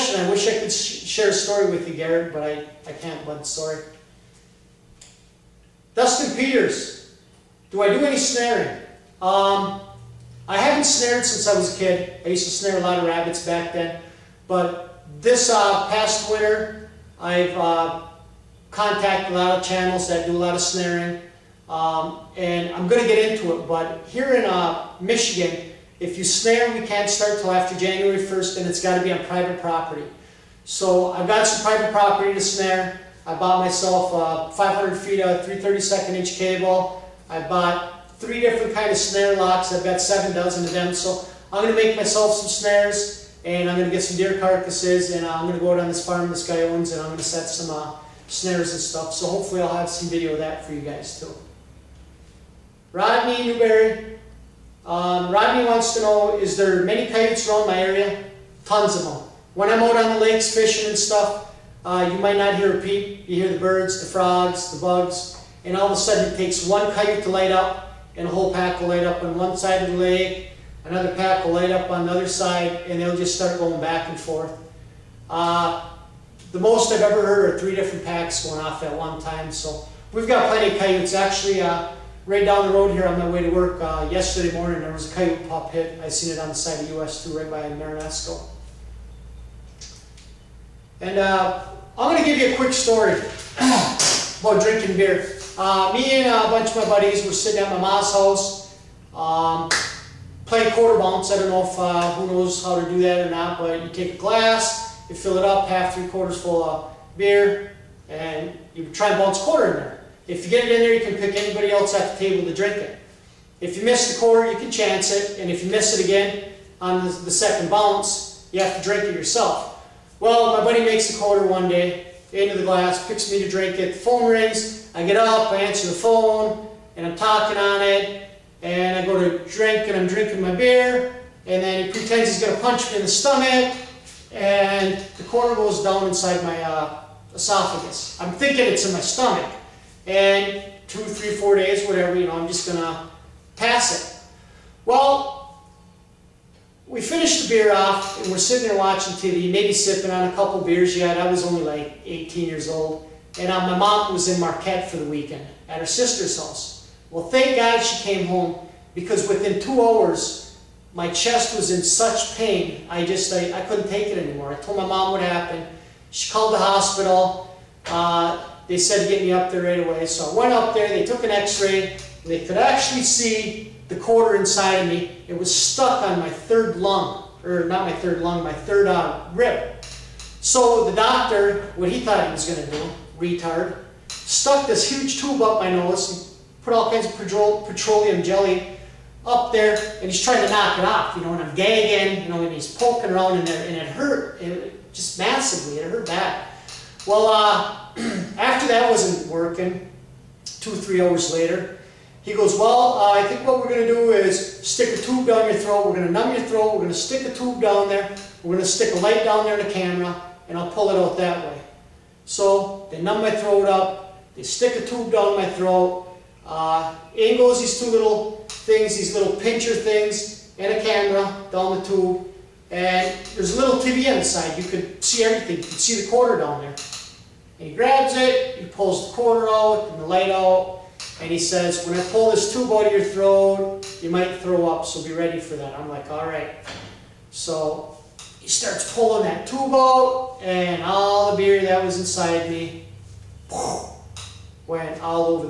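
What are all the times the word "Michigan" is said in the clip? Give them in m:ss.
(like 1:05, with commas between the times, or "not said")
0:24.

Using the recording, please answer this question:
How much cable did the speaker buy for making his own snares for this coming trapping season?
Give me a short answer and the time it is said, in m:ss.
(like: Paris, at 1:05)
500 feet, at 0:34.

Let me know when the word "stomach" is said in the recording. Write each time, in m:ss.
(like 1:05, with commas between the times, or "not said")
2:13, 2:18.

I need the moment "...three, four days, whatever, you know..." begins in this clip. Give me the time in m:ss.
2:20.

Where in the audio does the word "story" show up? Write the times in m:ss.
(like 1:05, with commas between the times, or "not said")
0:01, 1:32.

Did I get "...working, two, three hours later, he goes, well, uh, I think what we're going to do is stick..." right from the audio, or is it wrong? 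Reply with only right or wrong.
right.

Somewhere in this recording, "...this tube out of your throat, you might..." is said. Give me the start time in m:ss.
3:52.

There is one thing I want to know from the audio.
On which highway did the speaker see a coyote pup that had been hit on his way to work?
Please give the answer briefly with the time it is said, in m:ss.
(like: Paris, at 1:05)
US 2, at 1:26.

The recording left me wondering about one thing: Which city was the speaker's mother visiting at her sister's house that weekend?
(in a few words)
Marquette.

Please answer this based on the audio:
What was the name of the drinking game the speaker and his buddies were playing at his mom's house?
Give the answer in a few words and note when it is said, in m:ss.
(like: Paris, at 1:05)
quarter bounce, at 1:40.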